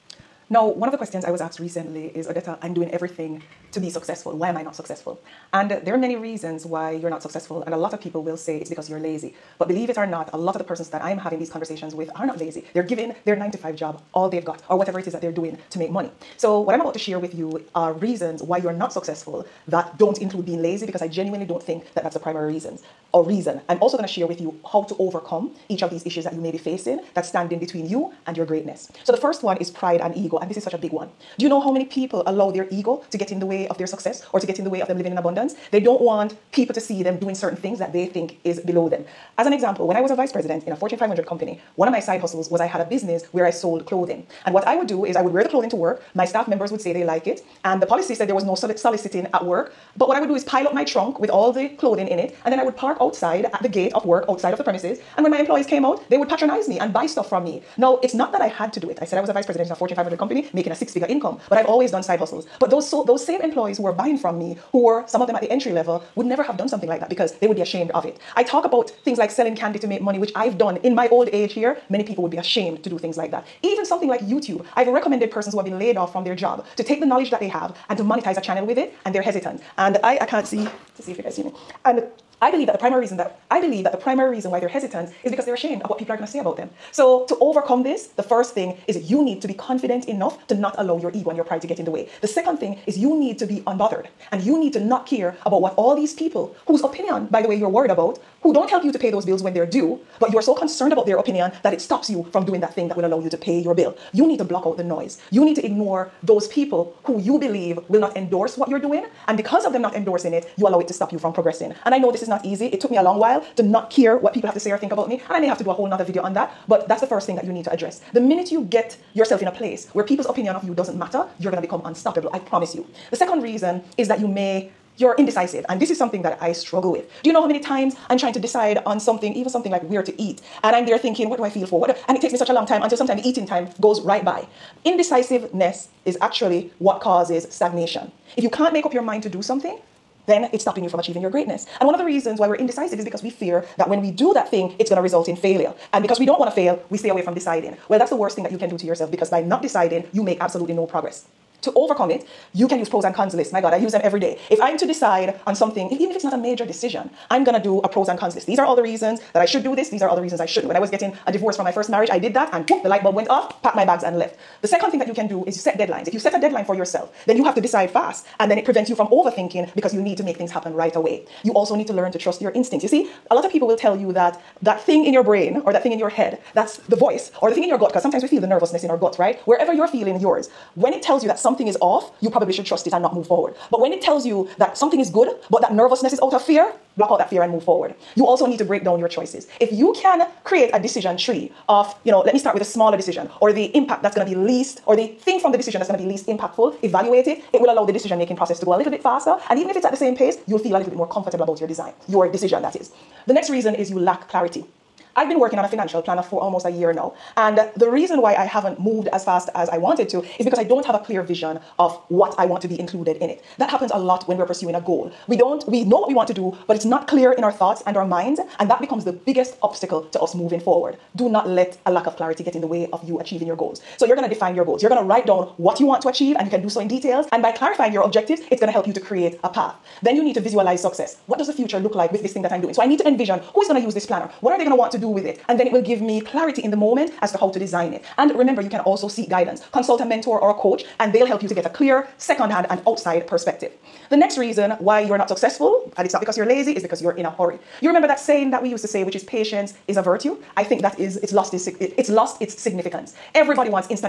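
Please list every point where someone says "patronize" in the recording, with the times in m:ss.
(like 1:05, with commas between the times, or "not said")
0:56.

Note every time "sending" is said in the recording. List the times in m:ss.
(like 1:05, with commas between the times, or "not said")
not said.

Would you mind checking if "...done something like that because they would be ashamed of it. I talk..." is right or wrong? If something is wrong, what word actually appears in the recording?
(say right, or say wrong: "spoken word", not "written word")
right.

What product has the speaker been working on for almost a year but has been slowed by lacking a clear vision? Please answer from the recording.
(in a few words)
Financial planner.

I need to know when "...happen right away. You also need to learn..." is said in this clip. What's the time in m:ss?
2:50.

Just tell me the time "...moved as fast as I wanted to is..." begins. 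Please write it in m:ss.
3:28.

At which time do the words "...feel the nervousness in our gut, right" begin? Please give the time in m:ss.
2:58.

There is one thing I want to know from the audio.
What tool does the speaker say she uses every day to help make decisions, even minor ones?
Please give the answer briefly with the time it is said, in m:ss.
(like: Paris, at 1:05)
Pros and cons lists, at 2:32.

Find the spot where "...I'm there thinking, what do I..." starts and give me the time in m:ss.
2:10.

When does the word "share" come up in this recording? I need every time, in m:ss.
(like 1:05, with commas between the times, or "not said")
0:16, 0:24.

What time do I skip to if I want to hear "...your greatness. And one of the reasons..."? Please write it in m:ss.
2:21.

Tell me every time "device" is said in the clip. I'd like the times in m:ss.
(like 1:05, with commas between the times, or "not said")
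not said.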